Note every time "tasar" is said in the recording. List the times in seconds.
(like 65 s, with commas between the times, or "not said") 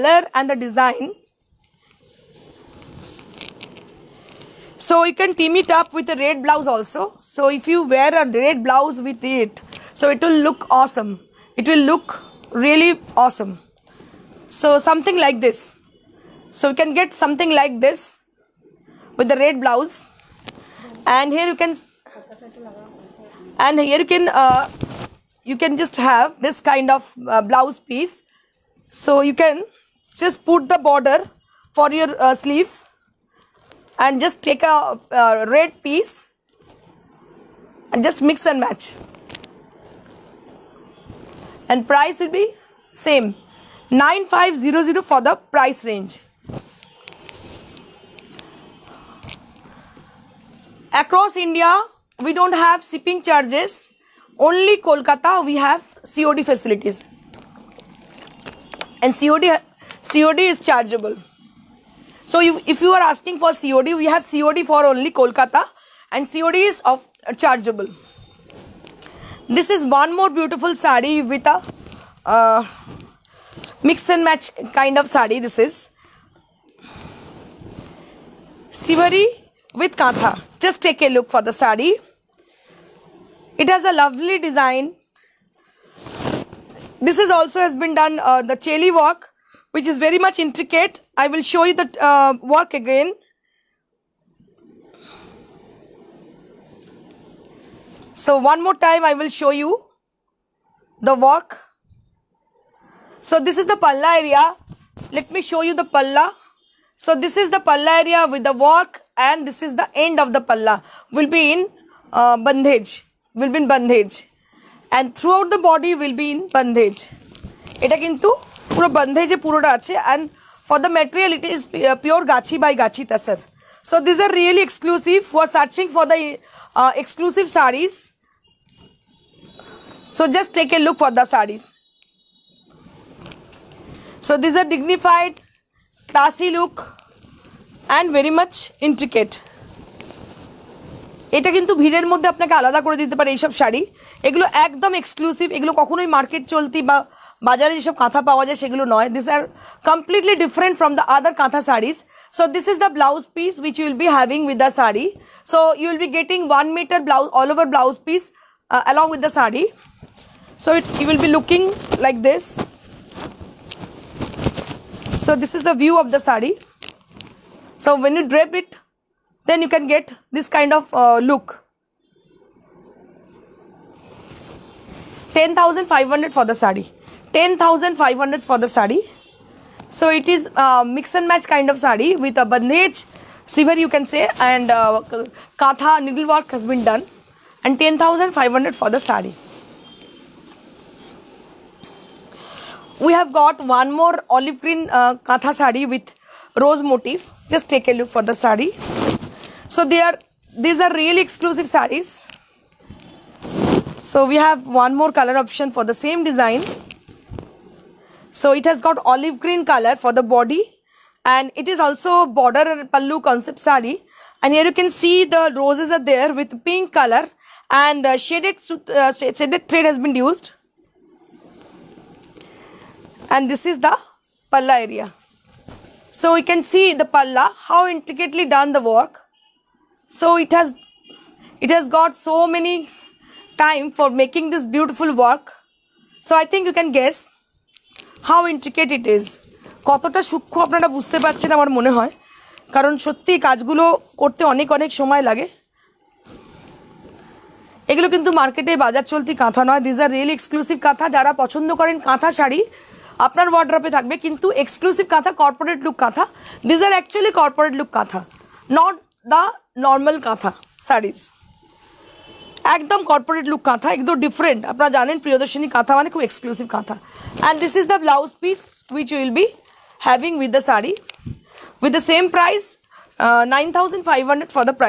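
123 s.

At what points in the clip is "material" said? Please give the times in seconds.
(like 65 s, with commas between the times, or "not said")
120 s.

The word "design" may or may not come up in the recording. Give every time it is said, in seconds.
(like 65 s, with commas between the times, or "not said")
0 s, 84 s, 206 s.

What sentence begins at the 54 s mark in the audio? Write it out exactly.
Only Kolkata, we have COD facilities.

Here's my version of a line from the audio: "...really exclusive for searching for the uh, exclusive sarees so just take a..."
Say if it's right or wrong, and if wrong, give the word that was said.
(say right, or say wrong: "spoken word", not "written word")
right.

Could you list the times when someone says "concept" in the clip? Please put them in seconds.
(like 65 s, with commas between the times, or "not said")
213 s.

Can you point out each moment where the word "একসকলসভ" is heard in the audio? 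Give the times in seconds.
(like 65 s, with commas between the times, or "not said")
145 s, 250 s, 254 s, 266 s.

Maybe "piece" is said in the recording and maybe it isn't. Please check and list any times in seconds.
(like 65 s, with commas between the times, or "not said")
27 s, 35 s.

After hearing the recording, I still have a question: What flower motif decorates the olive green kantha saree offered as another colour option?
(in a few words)
rose.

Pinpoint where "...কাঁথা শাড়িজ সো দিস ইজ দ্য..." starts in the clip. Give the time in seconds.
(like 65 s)
151 s.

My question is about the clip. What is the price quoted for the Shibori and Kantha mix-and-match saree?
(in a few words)
10,500.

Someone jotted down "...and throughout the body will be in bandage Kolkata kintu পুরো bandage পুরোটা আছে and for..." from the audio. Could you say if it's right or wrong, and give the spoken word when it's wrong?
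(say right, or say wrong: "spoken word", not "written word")
wrong: "Ita", not "Kolkata".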